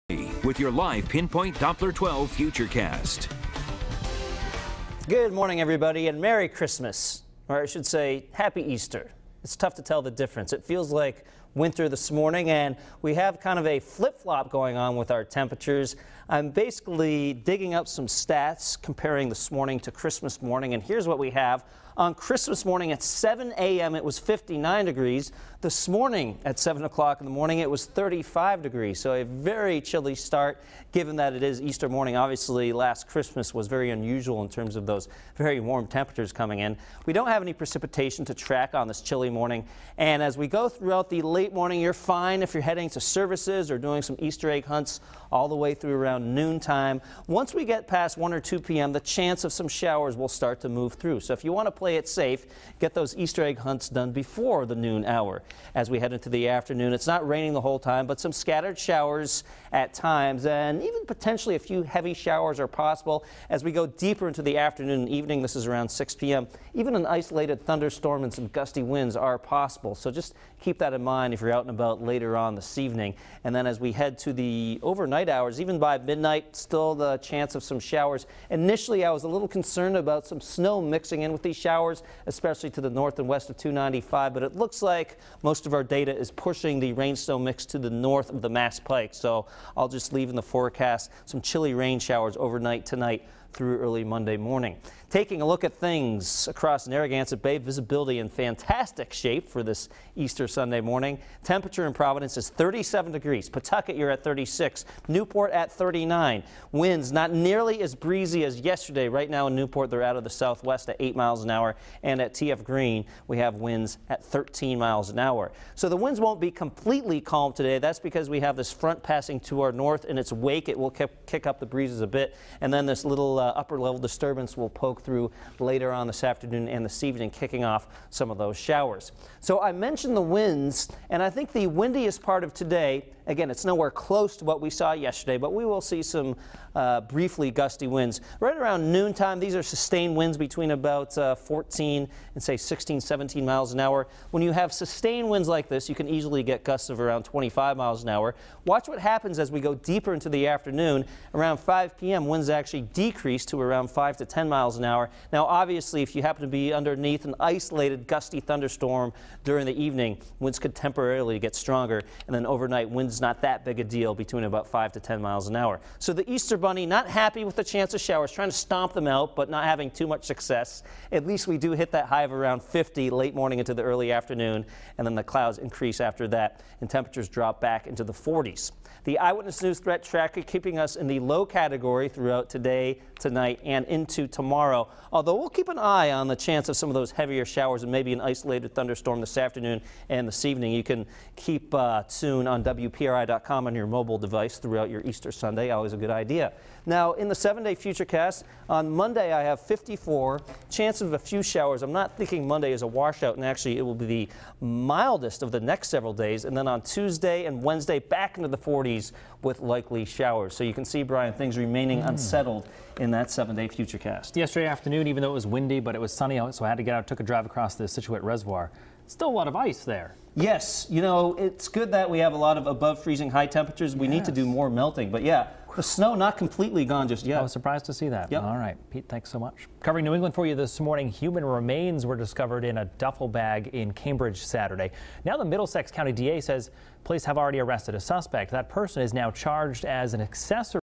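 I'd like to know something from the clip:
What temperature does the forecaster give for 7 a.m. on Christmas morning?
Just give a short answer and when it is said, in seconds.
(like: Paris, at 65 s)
59 degrees, at 24 s.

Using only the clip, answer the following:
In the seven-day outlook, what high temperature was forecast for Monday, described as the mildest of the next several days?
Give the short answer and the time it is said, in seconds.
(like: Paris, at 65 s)
54, at 199 s.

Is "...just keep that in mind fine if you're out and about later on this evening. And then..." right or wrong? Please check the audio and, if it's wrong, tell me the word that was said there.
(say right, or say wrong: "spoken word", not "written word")
right.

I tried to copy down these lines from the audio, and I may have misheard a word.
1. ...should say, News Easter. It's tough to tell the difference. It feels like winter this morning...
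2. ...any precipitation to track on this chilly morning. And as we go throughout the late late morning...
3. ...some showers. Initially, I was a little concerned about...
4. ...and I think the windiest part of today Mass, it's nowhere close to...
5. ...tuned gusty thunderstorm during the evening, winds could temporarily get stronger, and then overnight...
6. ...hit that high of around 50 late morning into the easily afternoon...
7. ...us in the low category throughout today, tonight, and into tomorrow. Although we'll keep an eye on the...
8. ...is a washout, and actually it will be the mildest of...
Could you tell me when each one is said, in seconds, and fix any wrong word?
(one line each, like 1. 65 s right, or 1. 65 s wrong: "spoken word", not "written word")
1. 7 s wrong: "Happy", not "News"
2. 37 s right
3. 77 s right
4. 131 s wrong: "Again", not "Mass"
5. 157 s wrong: "isolated", not "tuned"
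6. 171 s wrong: "early", not "easily"
7. 180 s right
8. 202 s right.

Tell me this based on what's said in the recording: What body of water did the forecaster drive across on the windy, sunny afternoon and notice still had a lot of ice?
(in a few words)
Scituate Reservoir.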